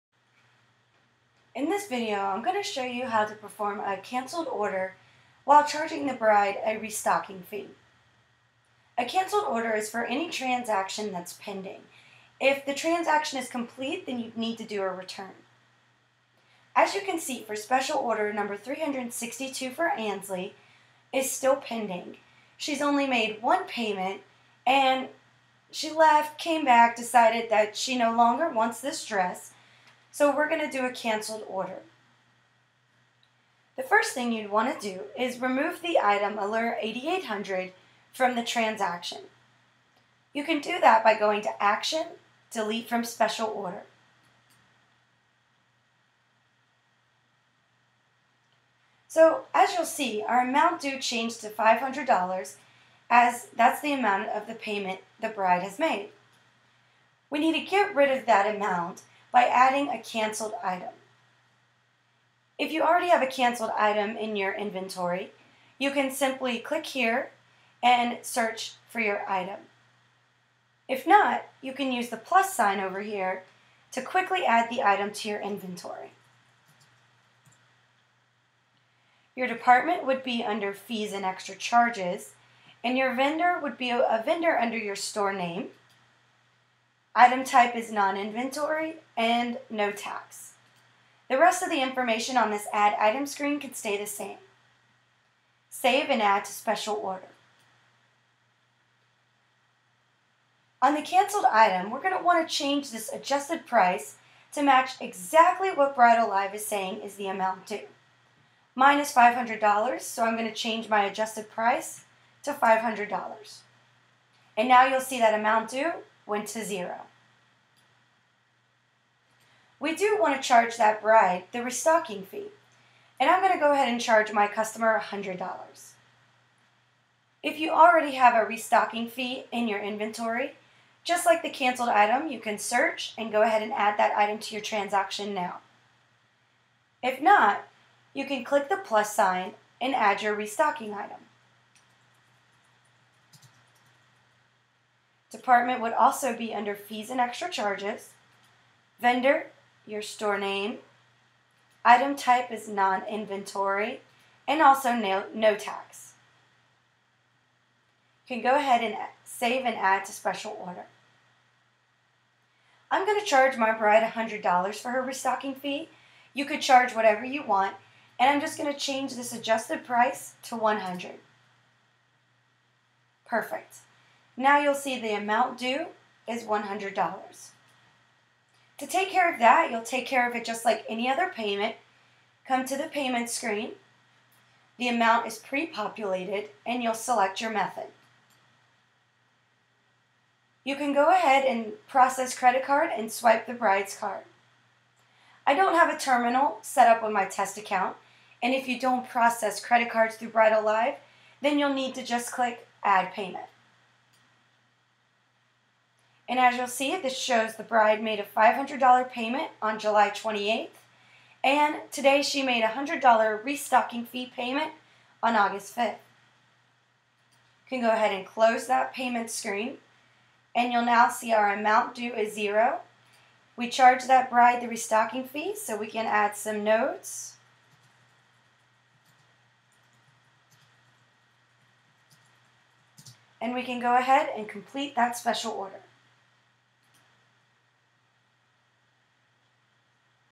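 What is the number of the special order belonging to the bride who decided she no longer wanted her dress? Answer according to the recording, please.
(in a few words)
362.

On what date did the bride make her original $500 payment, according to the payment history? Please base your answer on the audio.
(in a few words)
July 28th.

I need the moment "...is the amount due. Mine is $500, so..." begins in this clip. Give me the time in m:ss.
1:47.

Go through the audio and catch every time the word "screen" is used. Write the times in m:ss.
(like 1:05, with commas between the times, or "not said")
1:33, 3:03, 3:39.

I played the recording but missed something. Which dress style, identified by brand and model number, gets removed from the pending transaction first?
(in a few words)
Allure 8800.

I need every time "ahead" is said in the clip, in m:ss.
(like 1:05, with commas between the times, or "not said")
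2:03, 2:13, 2:38, 3:11, 3:37, 3:53.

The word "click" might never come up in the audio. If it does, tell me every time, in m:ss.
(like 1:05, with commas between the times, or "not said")
1:06, 2:18, 3:22.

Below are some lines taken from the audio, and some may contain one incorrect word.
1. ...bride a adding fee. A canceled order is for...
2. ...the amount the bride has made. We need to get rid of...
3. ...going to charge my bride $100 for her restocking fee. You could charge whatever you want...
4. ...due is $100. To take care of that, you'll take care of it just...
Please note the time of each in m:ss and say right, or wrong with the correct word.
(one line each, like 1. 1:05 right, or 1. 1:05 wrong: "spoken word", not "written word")
1. 0:06 wrong: "restocking", not "adding"
2. 0:54 wrong: "payment", not "amount"
3. 2:43 right
4. 2:55 right.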